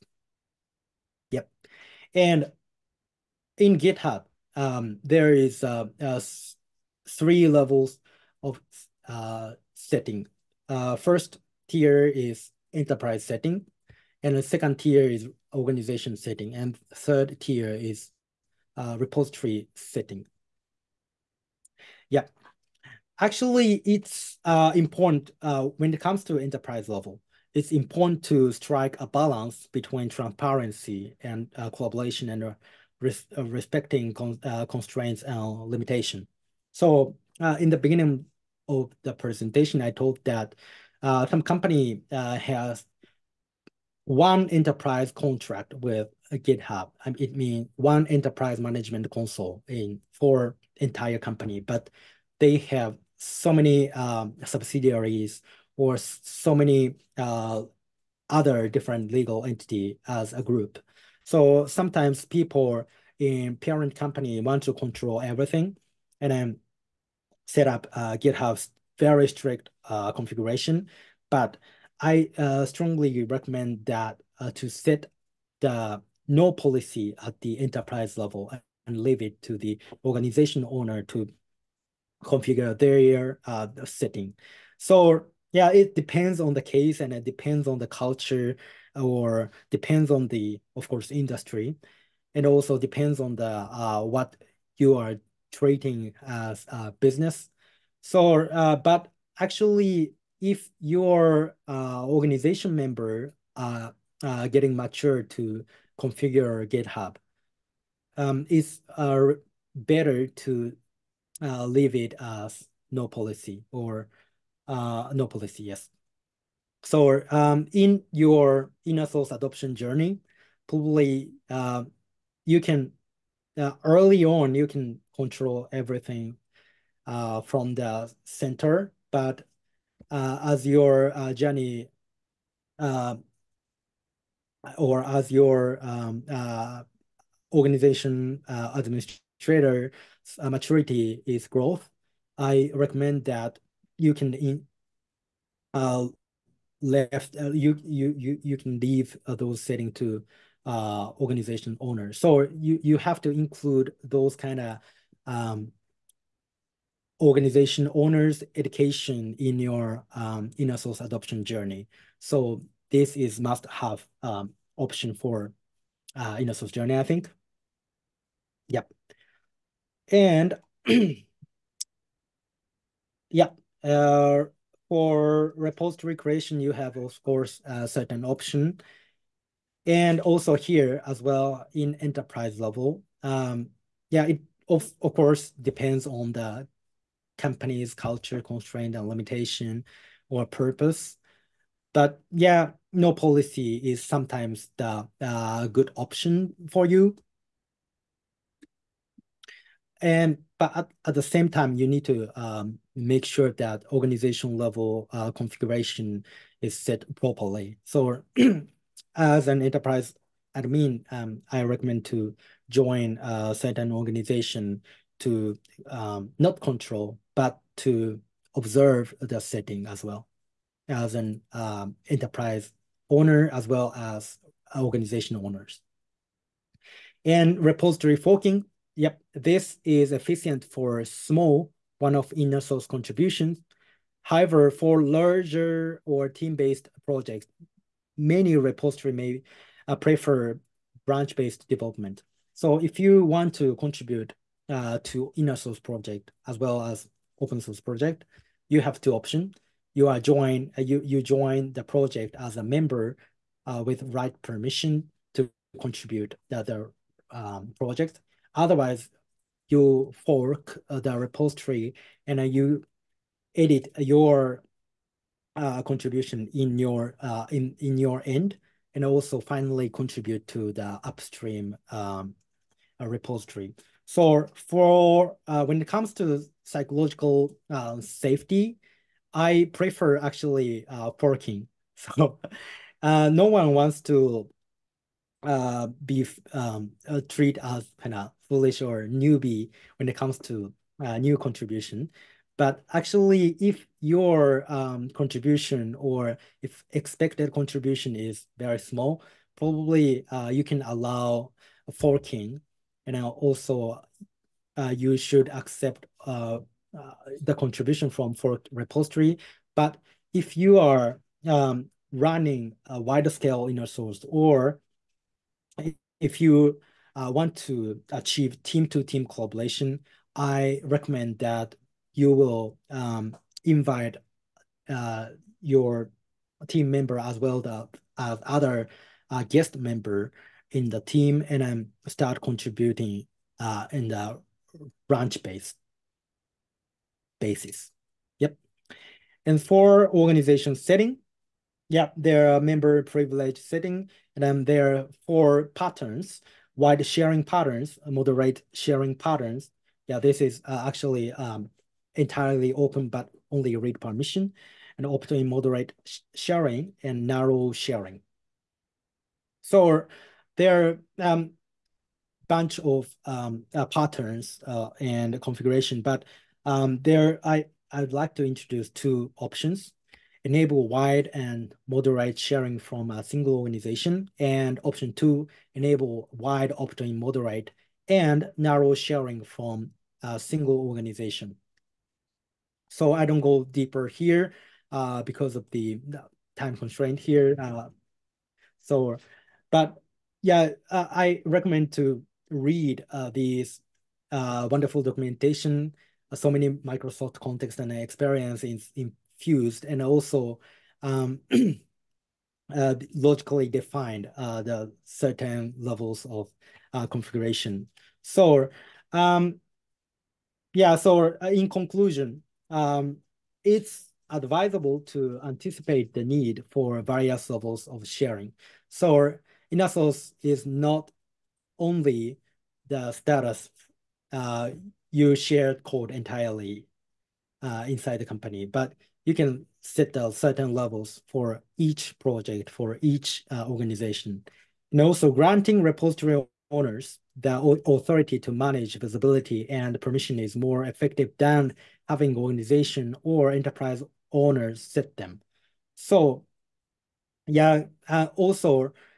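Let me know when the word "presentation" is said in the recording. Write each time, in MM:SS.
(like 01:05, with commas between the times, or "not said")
00:39.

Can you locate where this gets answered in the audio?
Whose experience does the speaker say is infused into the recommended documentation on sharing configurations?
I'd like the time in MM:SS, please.
06:36.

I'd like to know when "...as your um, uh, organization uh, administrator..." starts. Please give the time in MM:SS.
02:15.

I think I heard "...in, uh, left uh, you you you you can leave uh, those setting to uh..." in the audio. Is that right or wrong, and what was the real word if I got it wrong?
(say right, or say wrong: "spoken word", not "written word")
right.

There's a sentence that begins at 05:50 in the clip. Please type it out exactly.
Yeah, this is uh, actually um, entirely open, but only read permission and opt moderate sh sharing and narrow sharing.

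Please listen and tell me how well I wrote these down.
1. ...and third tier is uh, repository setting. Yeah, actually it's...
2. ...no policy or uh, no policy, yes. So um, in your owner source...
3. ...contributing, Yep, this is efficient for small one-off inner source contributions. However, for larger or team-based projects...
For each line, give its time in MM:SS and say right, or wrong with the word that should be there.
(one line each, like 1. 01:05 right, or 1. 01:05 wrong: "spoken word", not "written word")
1. 00:16 right
2. 01:52 wrong: "inner", not "owner"
3. 03:48 wrong: "forking", not "contributing".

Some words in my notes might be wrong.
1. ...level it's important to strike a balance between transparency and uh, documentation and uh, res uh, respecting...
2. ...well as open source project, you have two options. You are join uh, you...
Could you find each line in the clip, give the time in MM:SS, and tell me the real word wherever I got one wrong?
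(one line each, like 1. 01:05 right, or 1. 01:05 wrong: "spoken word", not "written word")
1. 00:26 wrong: "collaboration", not "documentation"
2. 04:06 right.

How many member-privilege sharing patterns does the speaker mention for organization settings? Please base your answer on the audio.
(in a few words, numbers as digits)
4.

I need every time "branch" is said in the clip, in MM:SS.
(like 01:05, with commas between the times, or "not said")
04:01, 05:35.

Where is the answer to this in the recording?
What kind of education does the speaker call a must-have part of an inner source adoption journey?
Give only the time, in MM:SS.
02:37.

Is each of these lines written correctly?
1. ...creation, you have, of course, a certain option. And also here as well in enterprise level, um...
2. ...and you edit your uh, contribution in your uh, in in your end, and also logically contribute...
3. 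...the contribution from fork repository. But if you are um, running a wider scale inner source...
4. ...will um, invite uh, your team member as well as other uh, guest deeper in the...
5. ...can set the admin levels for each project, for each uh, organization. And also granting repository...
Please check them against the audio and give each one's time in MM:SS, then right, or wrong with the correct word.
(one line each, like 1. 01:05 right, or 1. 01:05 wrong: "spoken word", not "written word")
1. 02:56 right
2. 04:22 wrong: "finally", not "logically"
3. 05:07 right
4. 05:22 wrong: "member", not "deeper"
5. 07:09 wrong: "certain", not "admin".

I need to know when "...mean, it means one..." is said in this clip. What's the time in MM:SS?
00:47.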